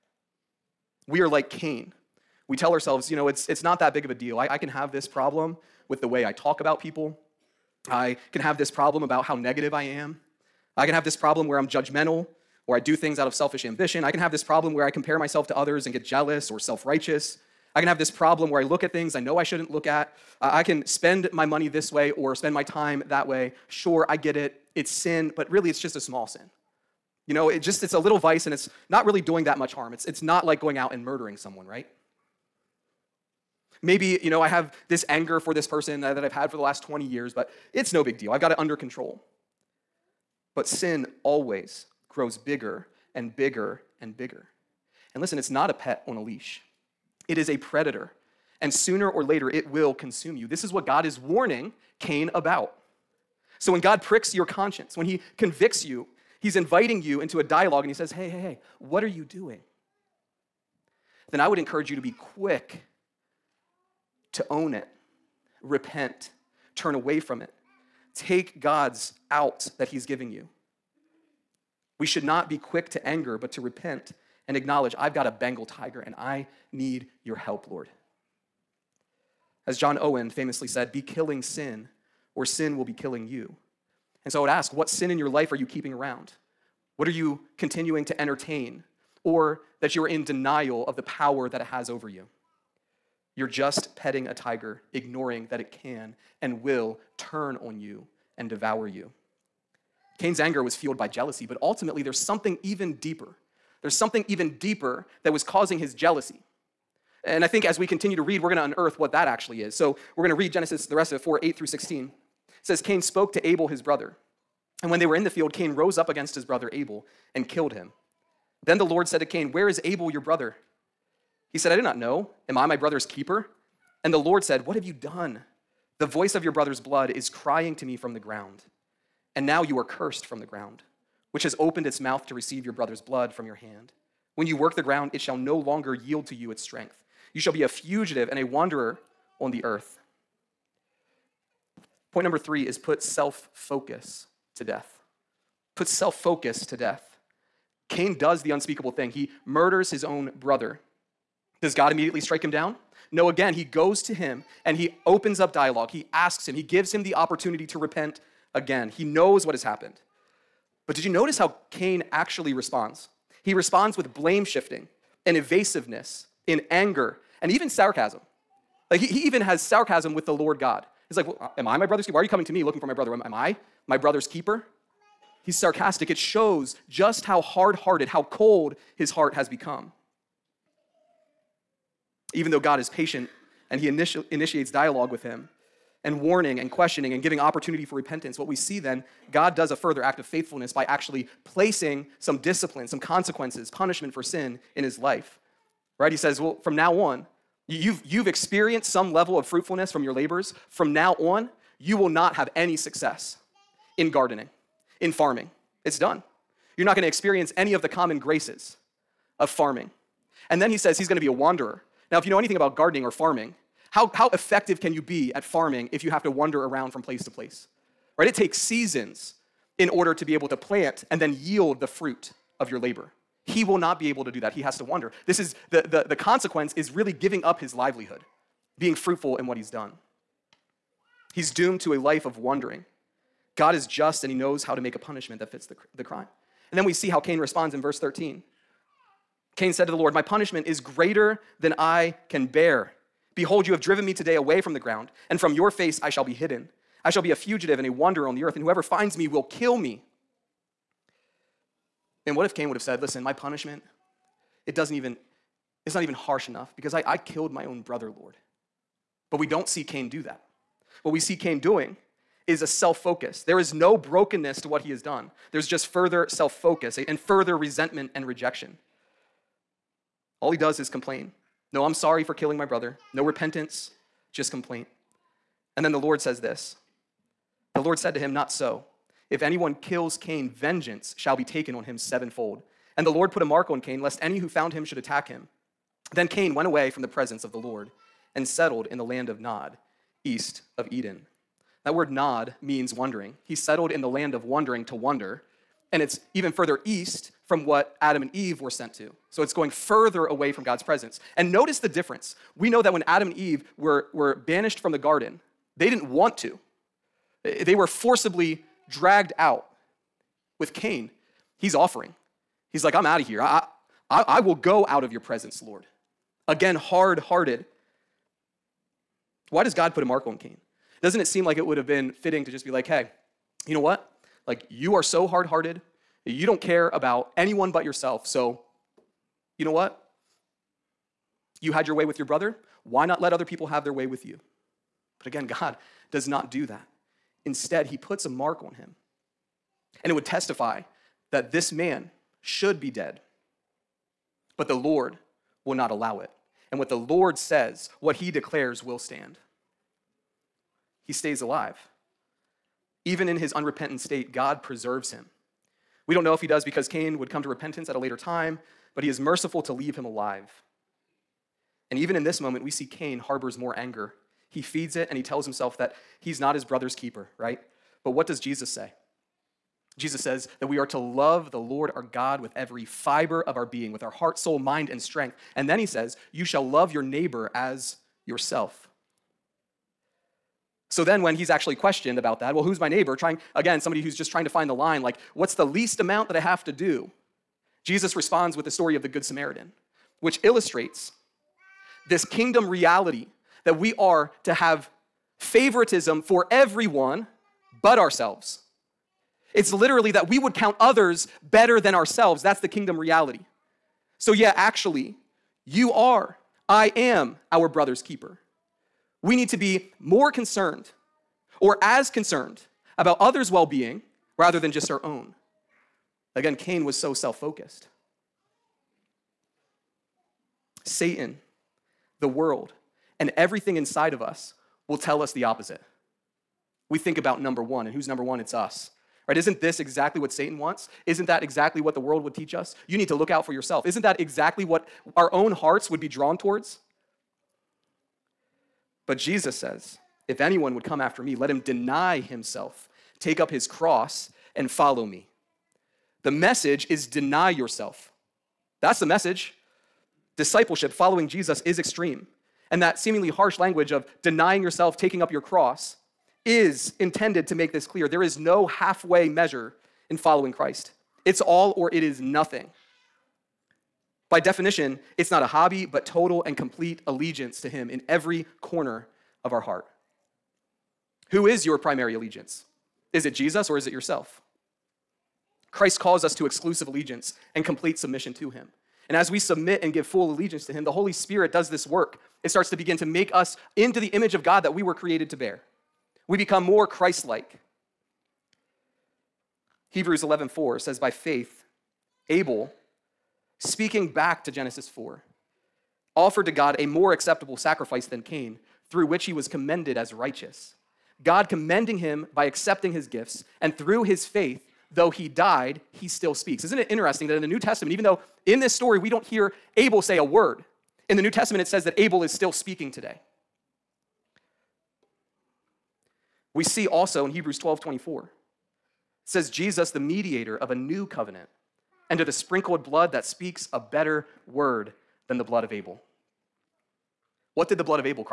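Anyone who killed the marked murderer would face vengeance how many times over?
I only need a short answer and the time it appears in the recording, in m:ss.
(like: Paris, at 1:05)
Sevenfold, at 4:41.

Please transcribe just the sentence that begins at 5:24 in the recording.
Like, you are so hard hearted.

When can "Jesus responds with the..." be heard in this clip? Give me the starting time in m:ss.
6:27.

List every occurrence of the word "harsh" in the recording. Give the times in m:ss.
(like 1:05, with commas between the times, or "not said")
4:16, 7:33.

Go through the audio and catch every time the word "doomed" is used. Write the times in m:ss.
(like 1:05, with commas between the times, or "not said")
3:51.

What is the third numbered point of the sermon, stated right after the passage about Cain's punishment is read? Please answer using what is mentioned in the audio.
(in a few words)
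Put self focus to death.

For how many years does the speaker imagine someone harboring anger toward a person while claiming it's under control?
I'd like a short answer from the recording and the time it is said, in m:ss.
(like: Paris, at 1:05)
20, at 0:36.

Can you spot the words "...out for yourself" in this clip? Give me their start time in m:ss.
7:13.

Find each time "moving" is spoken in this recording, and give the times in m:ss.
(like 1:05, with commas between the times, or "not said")
not said.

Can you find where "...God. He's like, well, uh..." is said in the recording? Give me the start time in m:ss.
2:50.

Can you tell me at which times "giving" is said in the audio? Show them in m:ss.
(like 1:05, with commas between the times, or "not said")
1:10, 3:07, 3:47.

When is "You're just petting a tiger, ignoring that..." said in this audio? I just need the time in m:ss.
1:33.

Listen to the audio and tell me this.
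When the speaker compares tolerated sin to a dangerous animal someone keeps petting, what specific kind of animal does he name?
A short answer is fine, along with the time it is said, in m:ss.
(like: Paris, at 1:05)
Bengal tiger, at 1:15.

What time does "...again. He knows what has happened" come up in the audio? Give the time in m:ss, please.
2:38.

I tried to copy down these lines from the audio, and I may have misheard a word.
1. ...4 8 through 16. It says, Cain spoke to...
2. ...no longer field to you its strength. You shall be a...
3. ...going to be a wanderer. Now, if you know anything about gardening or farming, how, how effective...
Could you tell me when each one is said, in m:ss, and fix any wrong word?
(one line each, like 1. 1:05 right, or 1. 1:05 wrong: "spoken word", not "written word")
1. 1:51 right
2. 2:15 wrong: "yield", not "field"
3. 3:31 right.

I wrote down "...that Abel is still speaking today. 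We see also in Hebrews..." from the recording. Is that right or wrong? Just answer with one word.
right.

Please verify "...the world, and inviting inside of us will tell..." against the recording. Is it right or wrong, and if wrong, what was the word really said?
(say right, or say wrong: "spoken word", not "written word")
wrong: "everything", not "inviting".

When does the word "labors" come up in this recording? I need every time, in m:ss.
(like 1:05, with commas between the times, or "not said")
3:20, 3:42.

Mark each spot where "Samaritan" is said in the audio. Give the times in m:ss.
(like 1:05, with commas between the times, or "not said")
6:29.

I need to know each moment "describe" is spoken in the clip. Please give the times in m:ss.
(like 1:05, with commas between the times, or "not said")
not said.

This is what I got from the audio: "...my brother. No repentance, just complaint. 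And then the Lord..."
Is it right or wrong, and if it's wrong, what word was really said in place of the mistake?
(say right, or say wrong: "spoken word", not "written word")
right.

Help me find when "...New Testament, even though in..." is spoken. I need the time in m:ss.
8:27.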